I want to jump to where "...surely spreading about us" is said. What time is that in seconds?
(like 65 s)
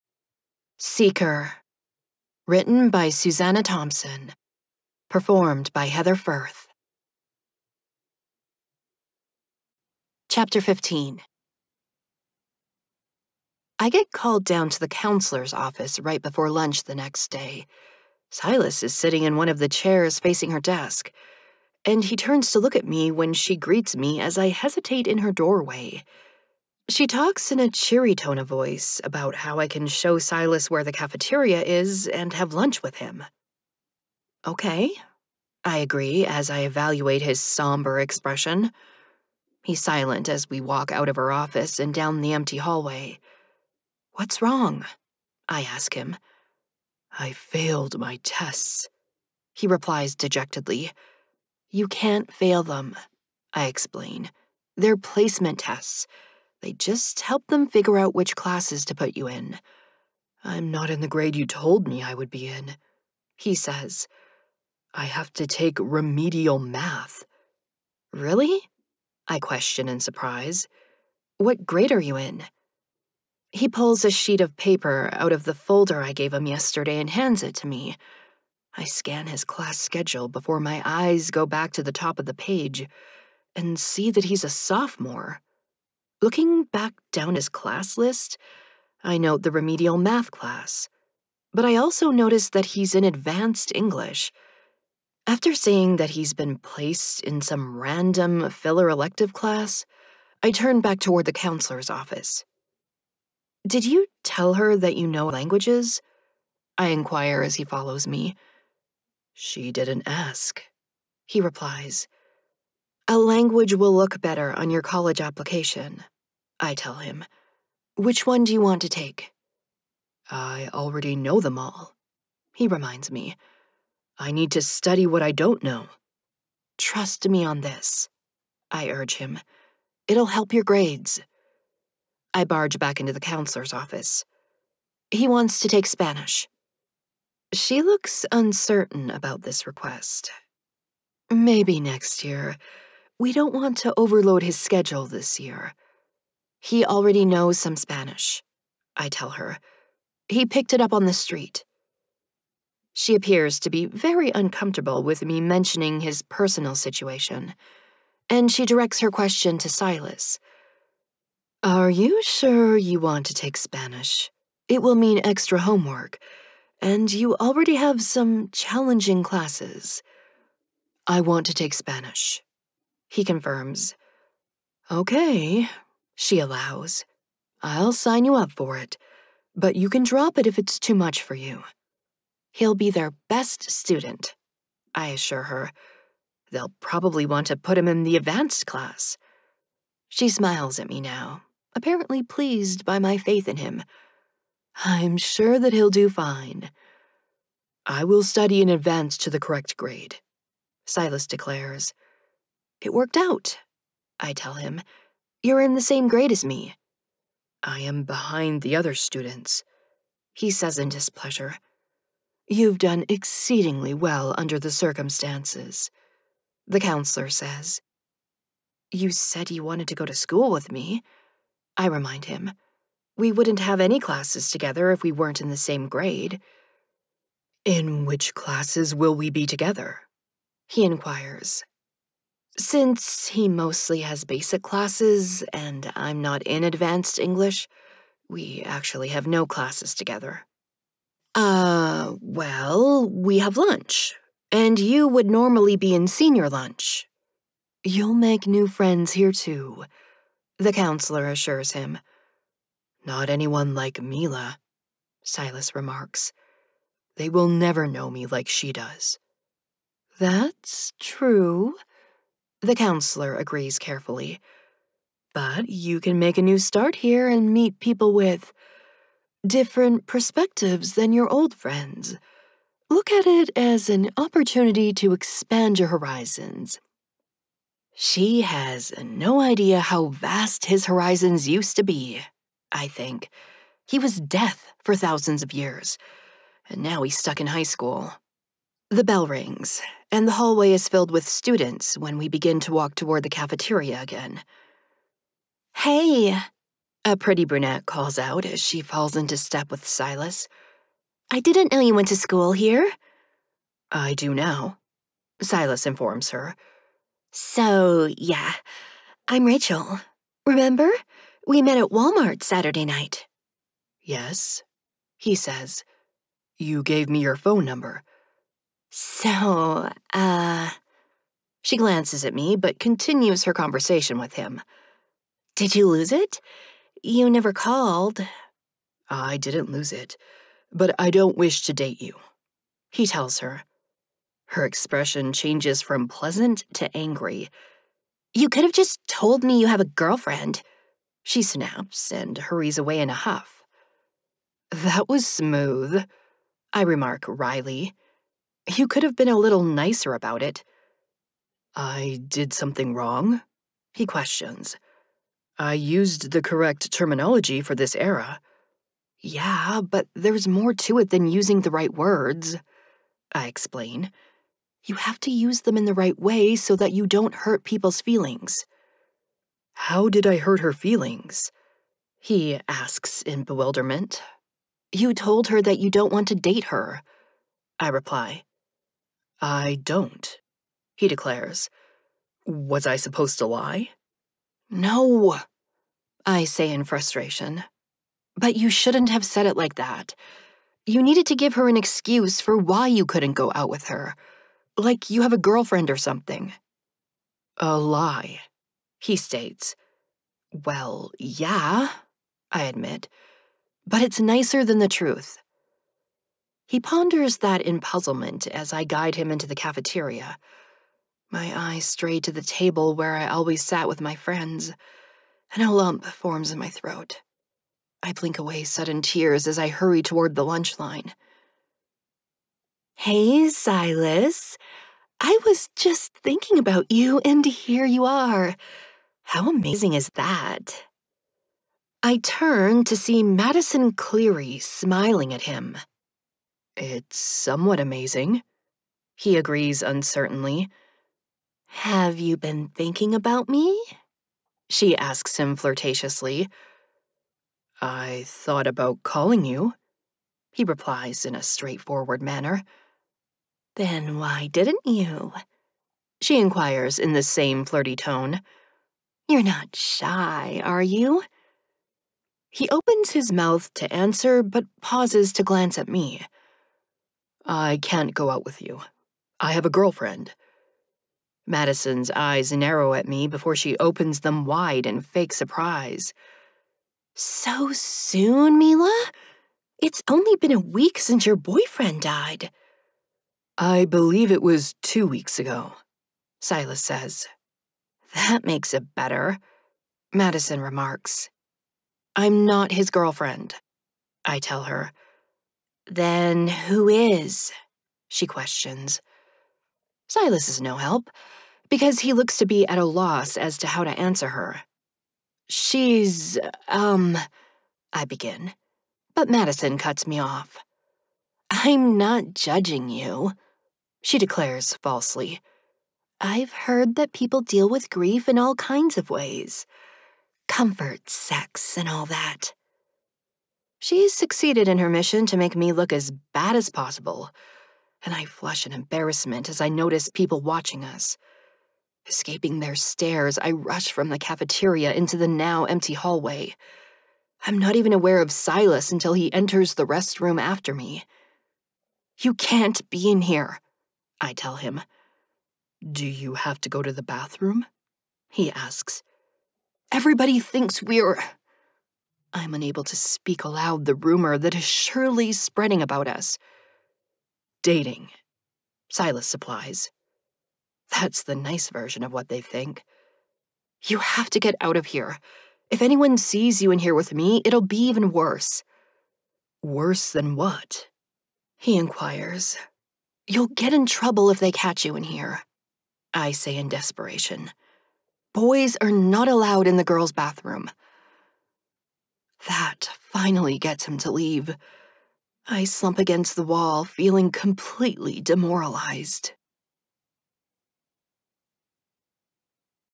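554 s.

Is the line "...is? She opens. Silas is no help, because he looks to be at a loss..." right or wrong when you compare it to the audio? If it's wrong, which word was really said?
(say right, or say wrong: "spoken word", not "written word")
wrong: "questions", not "opens".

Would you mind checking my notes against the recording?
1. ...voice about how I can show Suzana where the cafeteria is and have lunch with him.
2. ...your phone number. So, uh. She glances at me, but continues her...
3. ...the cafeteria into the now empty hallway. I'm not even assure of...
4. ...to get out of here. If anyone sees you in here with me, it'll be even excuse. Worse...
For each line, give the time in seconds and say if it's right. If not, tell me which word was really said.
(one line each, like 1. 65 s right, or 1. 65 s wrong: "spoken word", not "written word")
1. 28 s wrong: "Silas", not "Suzana"
2. 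317 s right
3. 534 s wrong: "aware", not "assure"
4. 564 s wrong: "worse", not "excuse".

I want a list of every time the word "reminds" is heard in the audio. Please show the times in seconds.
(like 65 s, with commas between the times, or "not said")
122 s, 221 s.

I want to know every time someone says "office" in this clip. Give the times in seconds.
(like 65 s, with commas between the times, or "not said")
15 s, 41 s, 101 s, 133 s.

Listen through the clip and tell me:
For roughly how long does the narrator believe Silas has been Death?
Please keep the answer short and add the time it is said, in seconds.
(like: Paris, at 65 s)
thousands of years, at 284 s.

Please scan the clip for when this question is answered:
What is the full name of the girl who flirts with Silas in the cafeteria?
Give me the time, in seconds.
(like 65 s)
433 s.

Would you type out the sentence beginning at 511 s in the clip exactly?
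I'm not judging you, she declares falsely.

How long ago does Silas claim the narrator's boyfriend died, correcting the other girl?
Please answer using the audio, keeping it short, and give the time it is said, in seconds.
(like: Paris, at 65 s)
two weeks ago, at 484 s.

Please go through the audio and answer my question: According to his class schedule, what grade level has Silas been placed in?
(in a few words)
sophomore.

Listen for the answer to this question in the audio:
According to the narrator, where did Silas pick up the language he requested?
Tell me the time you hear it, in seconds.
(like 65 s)
150 s.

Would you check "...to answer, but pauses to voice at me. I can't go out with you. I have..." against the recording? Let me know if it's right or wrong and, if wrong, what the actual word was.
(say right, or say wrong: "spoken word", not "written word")
wrong: "glance", not "voice".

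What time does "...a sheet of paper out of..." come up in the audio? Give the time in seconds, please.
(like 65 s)
74 s.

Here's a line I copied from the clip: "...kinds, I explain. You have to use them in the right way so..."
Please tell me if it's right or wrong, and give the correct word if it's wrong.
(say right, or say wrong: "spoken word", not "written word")
wrong: "words", not "kinds".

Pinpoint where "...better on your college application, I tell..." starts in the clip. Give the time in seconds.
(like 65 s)
114 s.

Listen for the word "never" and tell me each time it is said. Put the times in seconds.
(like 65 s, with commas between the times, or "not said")
257 s, 327 s.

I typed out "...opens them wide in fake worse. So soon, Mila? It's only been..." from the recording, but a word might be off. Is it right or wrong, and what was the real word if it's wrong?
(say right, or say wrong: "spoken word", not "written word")
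wrong: "surprise", not "worse".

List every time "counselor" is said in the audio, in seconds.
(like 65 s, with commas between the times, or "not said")
14 s, 101 s, 133 s, 216 s, 250 s, 262 s.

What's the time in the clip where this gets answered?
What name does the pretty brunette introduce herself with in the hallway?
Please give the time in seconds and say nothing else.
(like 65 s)
309 s.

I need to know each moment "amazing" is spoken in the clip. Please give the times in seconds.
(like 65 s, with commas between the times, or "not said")
429 s, 437 s.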